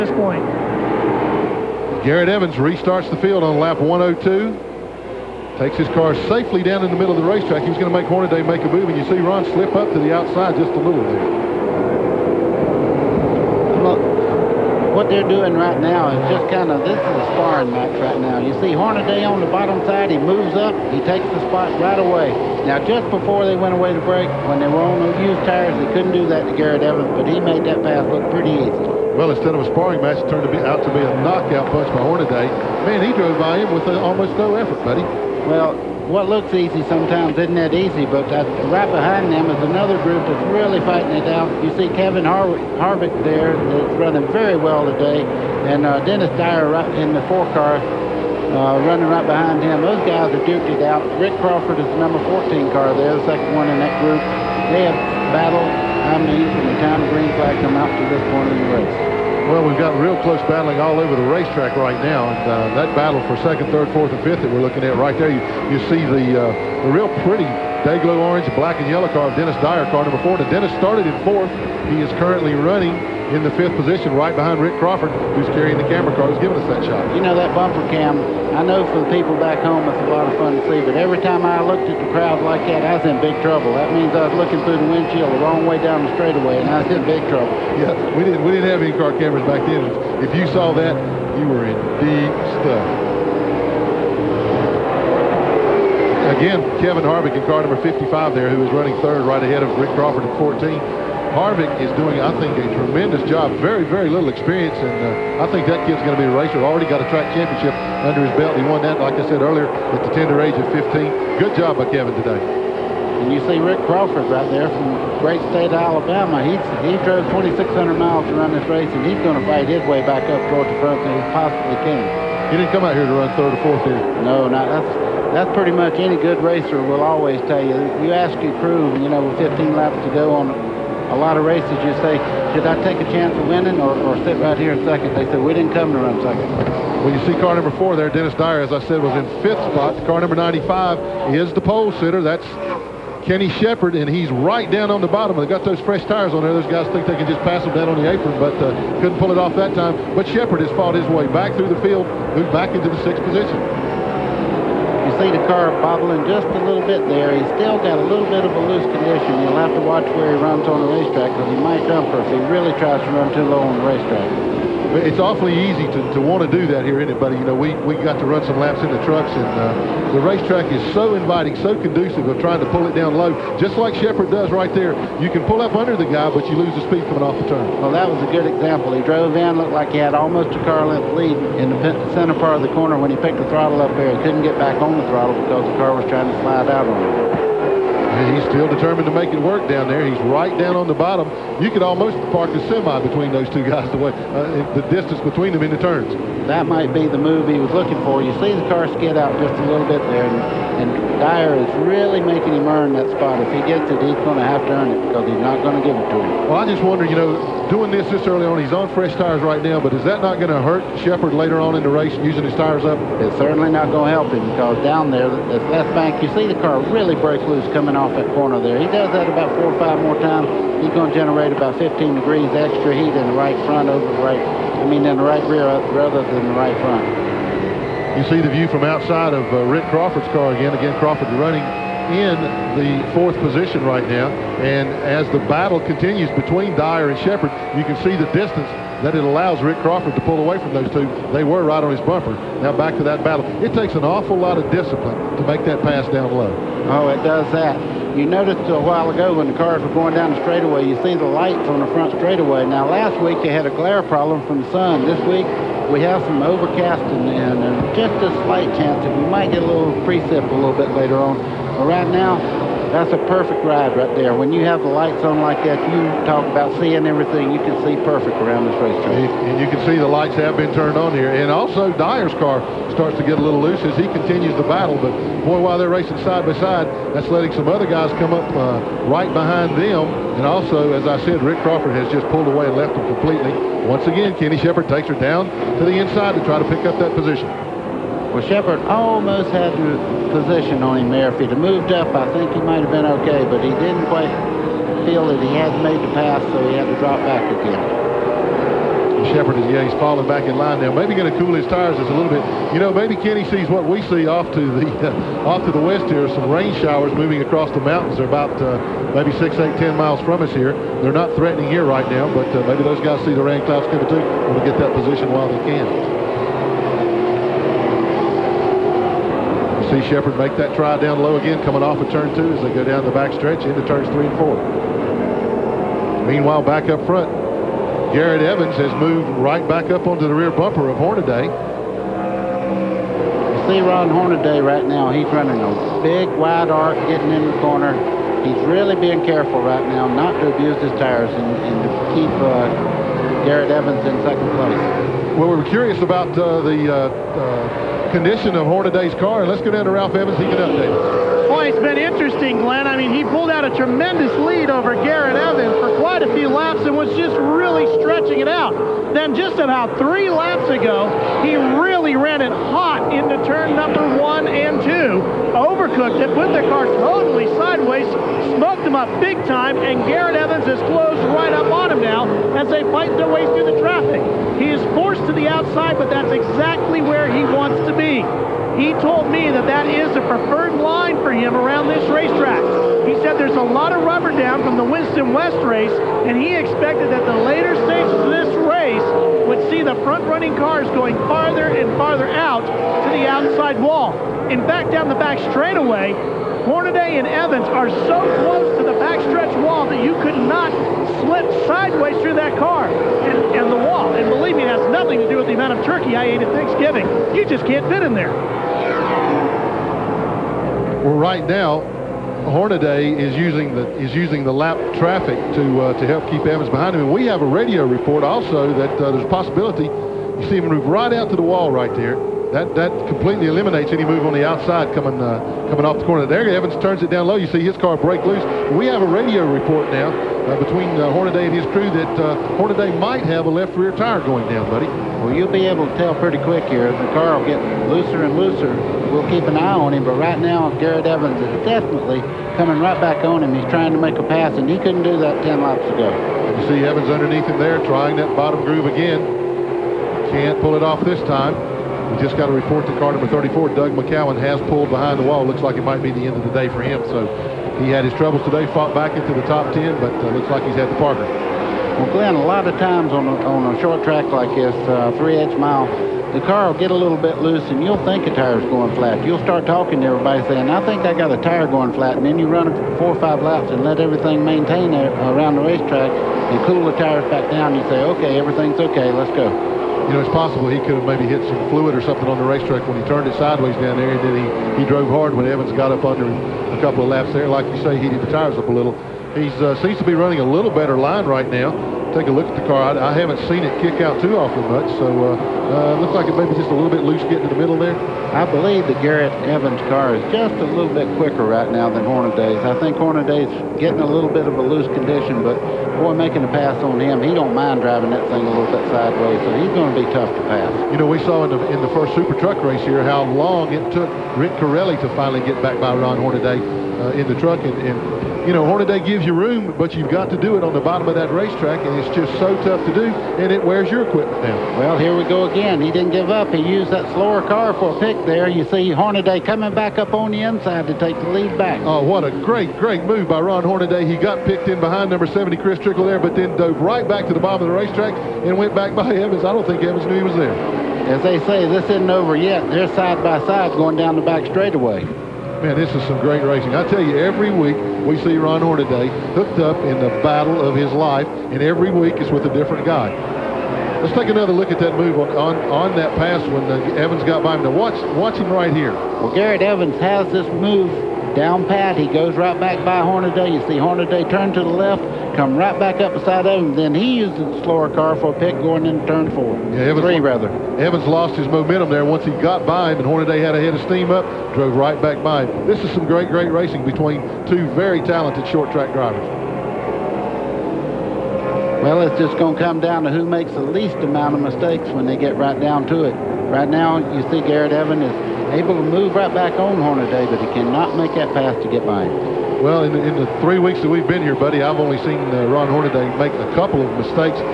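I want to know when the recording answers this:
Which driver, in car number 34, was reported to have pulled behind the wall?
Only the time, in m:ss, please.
7:33.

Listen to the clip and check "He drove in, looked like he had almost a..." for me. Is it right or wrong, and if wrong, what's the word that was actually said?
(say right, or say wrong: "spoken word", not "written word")
right.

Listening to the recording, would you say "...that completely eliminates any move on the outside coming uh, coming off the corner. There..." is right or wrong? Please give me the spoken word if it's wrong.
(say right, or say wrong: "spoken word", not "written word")
right.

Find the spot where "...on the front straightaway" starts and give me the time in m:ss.
4:11.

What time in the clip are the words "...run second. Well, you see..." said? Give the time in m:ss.
2:15.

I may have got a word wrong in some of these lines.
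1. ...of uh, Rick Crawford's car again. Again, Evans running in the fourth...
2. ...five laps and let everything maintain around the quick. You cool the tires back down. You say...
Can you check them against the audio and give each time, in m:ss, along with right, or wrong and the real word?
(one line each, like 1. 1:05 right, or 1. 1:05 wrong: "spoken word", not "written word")
1. 3:49 wrong: "Crawford", not "Evans"
2. 7:53 wrong: "racetrack", not "quick".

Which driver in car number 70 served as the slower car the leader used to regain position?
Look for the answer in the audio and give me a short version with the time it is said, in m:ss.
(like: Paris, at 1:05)
Chris Trickle, at 8:55.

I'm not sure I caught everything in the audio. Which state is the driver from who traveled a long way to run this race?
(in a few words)
Alabama.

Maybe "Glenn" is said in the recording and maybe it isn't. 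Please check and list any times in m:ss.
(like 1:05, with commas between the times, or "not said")
5:52, 7:42.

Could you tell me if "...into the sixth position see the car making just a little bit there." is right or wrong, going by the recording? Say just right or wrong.
wrong.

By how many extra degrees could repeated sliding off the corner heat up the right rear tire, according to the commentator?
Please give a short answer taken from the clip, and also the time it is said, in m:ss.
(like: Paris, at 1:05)
15, at 3:41.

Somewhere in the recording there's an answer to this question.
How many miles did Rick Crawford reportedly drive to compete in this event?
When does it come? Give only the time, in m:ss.
1:57.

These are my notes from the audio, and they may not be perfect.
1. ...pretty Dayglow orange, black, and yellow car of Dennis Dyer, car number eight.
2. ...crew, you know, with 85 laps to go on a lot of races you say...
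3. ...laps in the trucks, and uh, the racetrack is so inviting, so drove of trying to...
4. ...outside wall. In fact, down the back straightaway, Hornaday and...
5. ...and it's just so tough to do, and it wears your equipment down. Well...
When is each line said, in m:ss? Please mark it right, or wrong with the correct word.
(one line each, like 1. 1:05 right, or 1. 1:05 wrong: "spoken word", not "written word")
1. 1:07 wrong: "four", not "eight"
2. 2:08 wrong: "15", not "85"
3. 2:48 wrong: "conducive", not "drove"
4. 6:33 right
5. 8:41 right.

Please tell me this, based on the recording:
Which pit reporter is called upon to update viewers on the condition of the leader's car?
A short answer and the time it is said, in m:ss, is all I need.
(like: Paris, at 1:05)
Ralph Evans, at 5:49.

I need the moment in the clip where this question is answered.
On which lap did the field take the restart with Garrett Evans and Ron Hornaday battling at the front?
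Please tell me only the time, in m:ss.
0:03.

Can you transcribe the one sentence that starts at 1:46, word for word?
Already got a track championship under his belt.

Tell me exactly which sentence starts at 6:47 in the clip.
You just can't fit in there.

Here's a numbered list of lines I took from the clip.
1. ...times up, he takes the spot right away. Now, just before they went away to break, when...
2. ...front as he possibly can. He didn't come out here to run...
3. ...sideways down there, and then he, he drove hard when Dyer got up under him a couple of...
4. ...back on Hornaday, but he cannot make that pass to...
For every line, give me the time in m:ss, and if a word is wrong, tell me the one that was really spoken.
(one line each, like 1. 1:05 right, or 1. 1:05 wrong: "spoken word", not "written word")
1. 0:20 wrong: "moves", not "times"
2. 2:00 right
3. 8:03 wrong: "Evans", not "Dyer"
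4. 9:49 right.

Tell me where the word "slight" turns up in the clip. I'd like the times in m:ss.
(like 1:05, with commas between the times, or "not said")
4:18.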